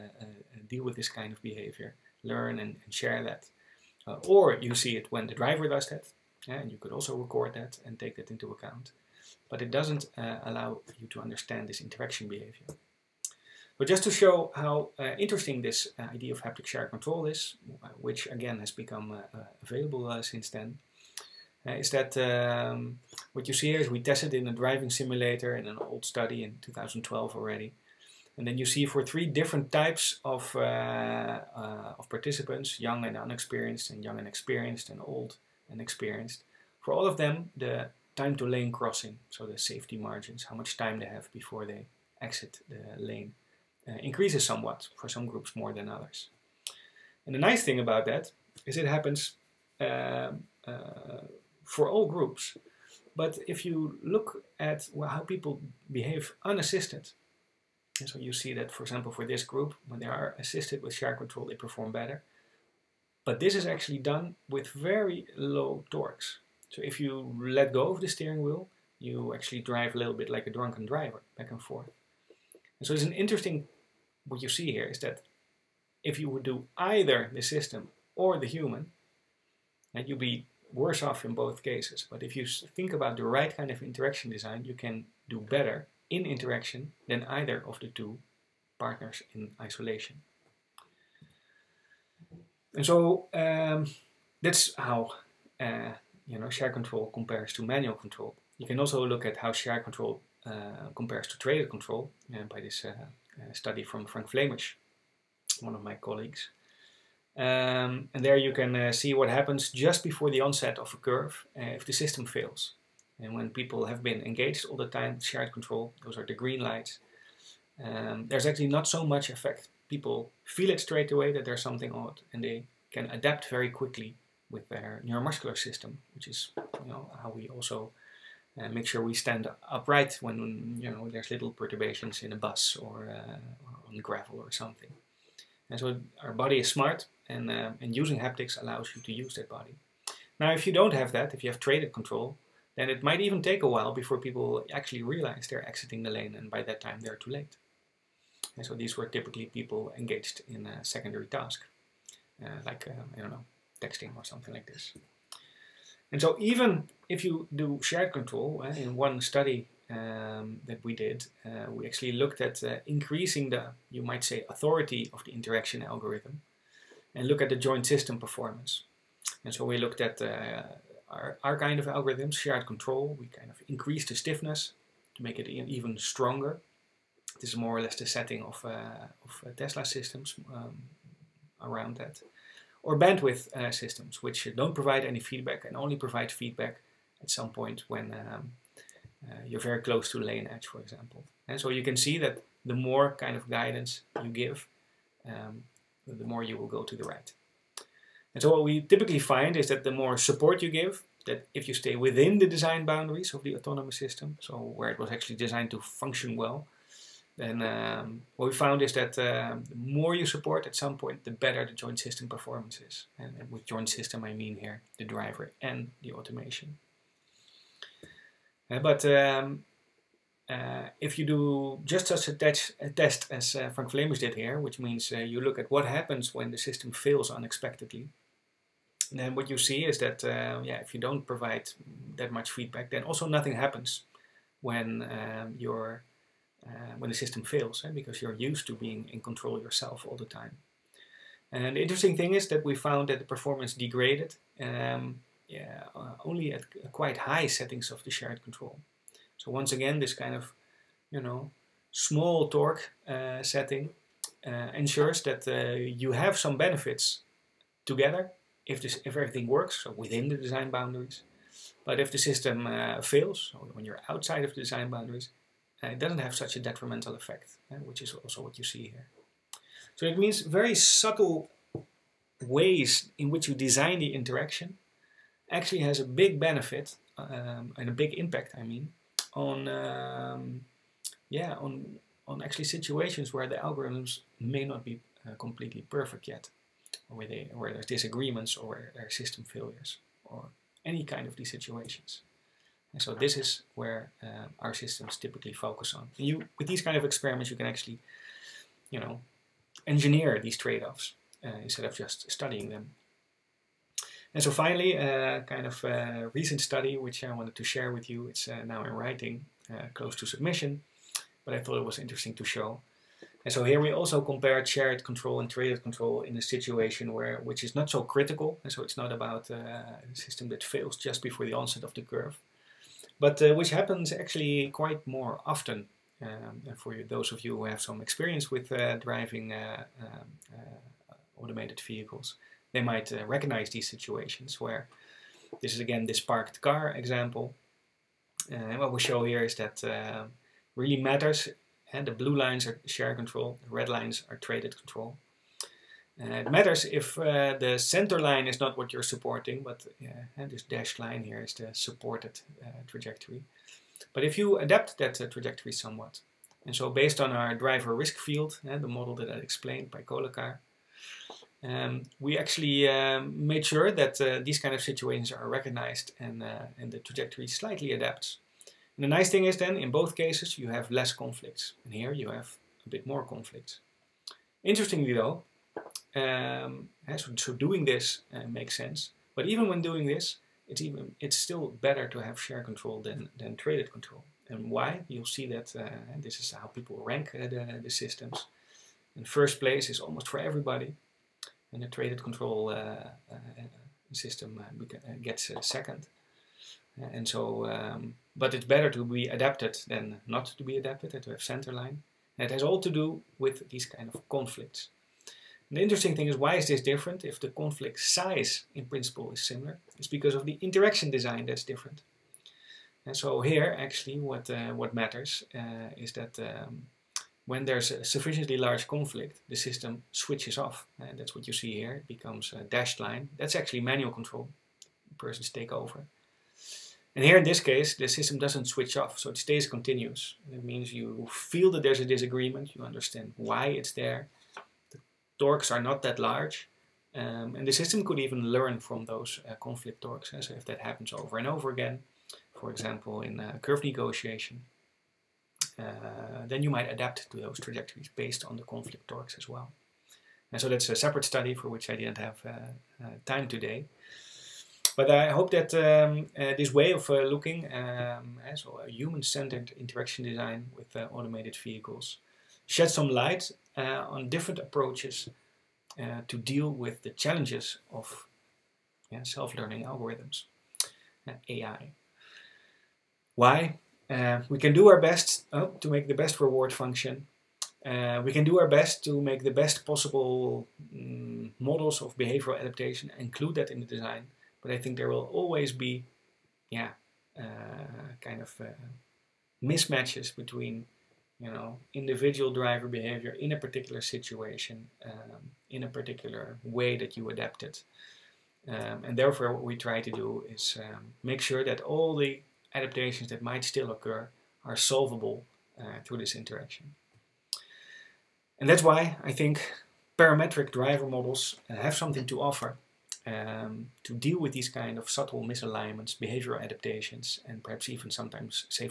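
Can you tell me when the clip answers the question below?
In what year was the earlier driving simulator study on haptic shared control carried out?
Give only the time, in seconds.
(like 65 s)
26 s.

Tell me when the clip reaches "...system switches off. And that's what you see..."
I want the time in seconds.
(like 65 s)
419 s.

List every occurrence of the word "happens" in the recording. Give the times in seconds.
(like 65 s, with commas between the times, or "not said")
48 s, 109 s, 225 s, 233 s, 323 s, 440 s.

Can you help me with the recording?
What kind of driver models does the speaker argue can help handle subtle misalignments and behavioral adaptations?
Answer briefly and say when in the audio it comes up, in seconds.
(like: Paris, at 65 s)
Parametric driver models, at 510 s.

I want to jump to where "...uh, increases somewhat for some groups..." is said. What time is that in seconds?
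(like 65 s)
43 s.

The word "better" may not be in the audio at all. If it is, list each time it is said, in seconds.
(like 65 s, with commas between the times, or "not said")
61 s, 85 s, 211 s, 381 s, 398 s.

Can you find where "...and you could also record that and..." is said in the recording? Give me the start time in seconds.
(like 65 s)
6 s.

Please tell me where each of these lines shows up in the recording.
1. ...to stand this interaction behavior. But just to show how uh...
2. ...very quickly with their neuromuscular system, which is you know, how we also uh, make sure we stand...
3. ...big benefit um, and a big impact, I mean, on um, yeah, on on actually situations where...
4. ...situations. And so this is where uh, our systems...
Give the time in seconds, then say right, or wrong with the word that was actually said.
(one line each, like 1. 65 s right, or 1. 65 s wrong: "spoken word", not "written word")
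1. 11 s wrong: "understand", not "stand"
2. 123 s right
3. 276 s right
4. 291 s right.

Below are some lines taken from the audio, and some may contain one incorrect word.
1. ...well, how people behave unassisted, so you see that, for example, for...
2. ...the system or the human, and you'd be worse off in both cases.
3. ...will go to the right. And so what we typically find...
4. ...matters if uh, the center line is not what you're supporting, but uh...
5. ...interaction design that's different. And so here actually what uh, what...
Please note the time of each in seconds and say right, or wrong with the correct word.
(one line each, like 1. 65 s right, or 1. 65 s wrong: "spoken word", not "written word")
1. 54 s right
2. 77 s right
3. 196 s right
4. 346 s right
5. 410 s right.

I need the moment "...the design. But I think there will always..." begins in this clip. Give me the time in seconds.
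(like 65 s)
483 s.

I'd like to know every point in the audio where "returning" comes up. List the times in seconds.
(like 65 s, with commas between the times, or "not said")
not said.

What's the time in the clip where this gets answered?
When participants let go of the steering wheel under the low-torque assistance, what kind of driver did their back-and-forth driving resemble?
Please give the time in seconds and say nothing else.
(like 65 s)
70 s.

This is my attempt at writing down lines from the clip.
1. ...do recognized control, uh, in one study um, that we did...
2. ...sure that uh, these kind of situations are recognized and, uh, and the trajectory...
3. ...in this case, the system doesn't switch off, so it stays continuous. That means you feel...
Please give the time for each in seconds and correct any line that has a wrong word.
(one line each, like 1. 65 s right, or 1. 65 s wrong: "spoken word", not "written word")
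1. 157 s wrong: "shared", not "recognized"
2. 363 s right
3. 427 s right.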